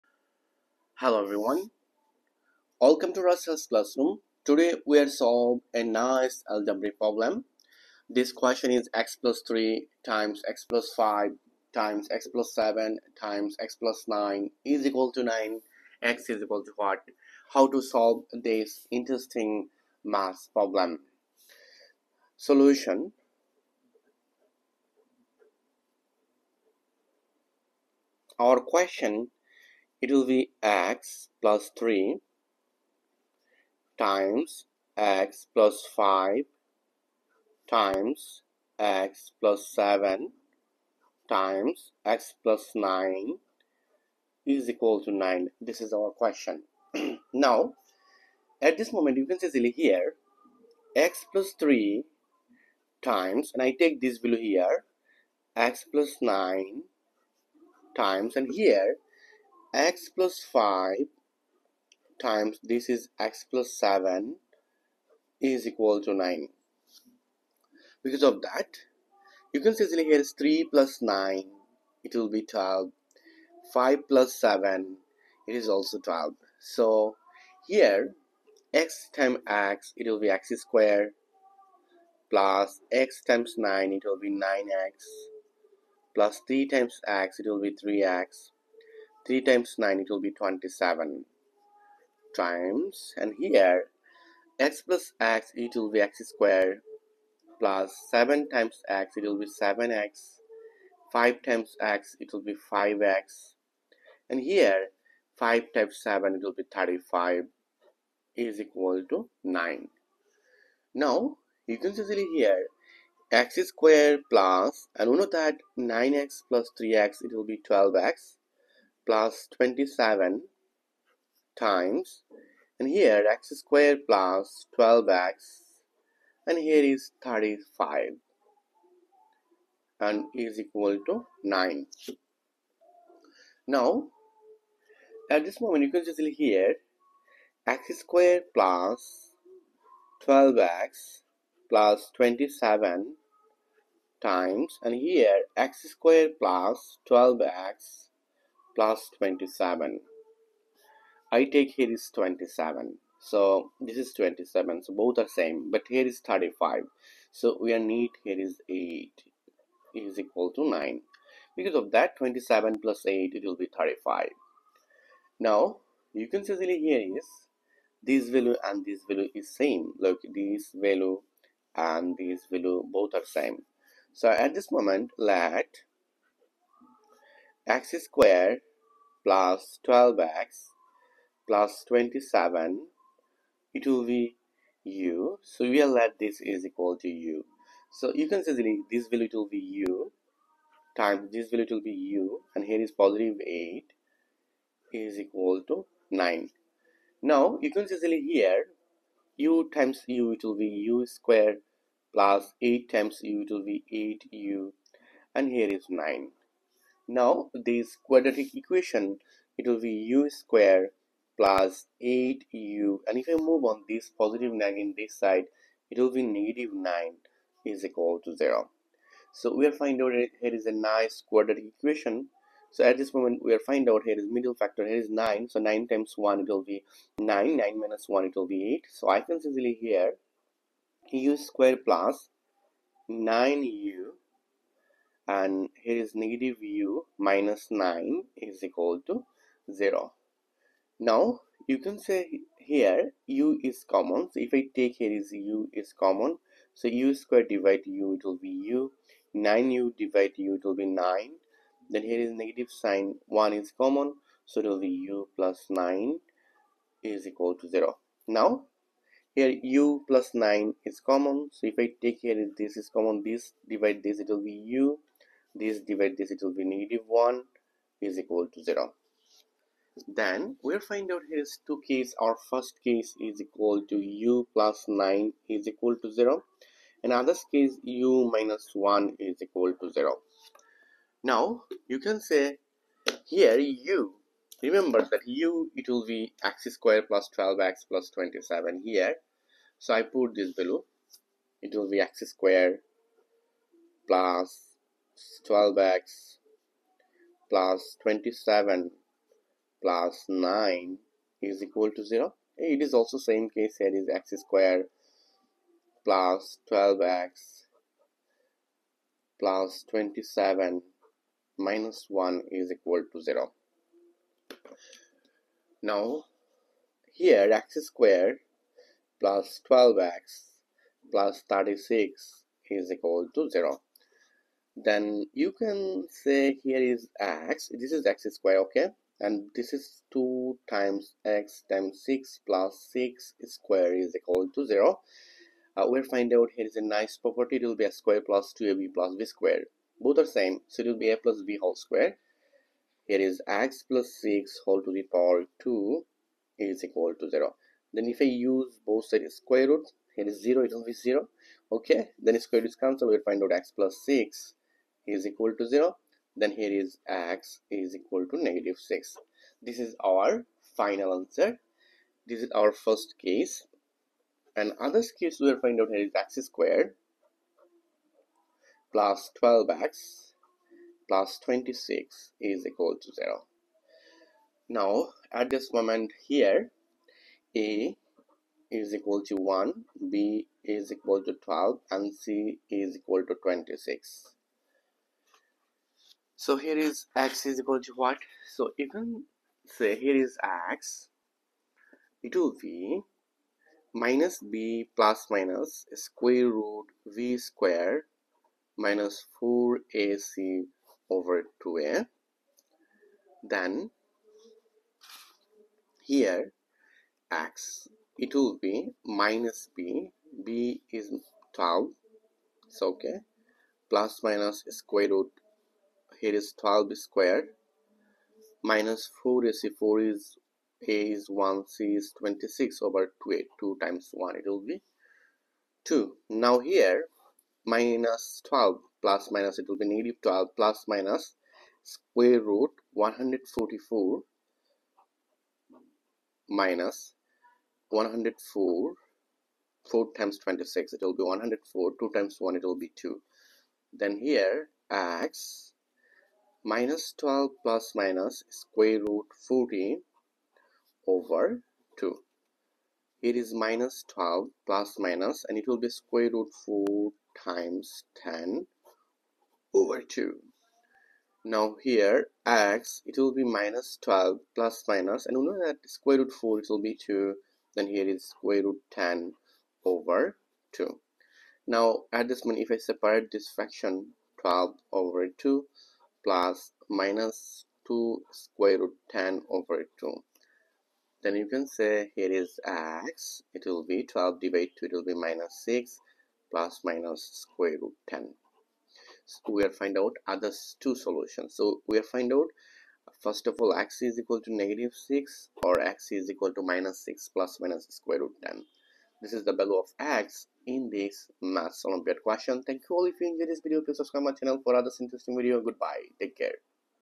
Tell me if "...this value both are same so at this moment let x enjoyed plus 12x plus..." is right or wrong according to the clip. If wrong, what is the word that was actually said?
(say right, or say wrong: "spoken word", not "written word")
wrong: "squared", not "enjoyed".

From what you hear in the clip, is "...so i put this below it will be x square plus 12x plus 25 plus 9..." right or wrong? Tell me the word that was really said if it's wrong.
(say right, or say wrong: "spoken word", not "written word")
wrong: "27", not "25".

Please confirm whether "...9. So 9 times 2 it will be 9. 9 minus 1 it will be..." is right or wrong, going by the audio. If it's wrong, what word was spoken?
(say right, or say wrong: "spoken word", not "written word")
wrong: "1", not "2".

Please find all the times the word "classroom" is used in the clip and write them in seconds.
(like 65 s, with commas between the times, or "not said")
3 s.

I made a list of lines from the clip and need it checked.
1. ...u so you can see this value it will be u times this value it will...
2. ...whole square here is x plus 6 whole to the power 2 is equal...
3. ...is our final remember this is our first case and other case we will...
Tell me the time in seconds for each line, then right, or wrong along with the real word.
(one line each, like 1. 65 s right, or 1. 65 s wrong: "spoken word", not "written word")
1. 187 s right
2. 341 s right
3. 359 s wrong: "answer", not "remember".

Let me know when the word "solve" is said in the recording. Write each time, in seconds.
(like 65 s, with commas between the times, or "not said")
5 s, 17 s.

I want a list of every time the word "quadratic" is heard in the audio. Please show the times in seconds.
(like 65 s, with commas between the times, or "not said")
207 s, 221 s.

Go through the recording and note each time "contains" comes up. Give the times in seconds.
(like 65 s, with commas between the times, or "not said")
not said.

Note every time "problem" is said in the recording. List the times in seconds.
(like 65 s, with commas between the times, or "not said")
6 s, 20 s.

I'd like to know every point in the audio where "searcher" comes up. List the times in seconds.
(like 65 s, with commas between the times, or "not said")
not said.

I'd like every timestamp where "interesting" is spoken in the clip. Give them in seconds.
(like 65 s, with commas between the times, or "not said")
18 s, 504 s.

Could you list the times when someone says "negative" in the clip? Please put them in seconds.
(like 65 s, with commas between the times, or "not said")
216 s, 236 s, 252 s, 266 s, 358 s, 429 s, 494 s.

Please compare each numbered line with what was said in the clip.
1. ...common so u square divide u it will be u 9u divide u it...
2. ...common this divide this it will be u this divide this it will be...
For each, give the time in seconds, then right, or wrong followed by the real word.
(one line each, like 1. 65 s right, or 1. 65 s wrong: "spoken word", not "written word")
1. 246 s right
2. 262 s right.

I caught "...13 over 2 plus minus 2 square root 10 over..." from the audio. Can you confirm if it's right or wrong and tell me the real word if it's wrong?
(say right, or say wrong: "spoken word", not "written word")
wrong: "12", not "13".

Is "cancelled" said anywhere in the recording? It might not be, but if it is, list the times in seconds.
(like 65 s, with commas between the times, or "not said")
352 s.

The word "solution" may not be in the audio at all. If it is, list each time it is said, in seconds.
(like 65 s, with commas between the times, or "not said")
22 s, 490 s.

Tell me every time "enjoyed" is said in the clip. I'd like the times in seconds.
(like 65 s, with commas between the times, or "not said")
503 s.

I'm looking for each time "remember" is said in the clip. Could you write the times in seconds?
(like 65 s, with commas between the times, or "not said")
284 s.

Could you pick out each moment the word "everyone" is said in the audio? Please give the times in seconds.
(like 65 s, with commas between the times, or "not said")
1 s.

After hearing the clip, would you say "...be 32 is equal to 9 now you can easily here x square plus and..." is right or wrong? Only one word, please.
wrong.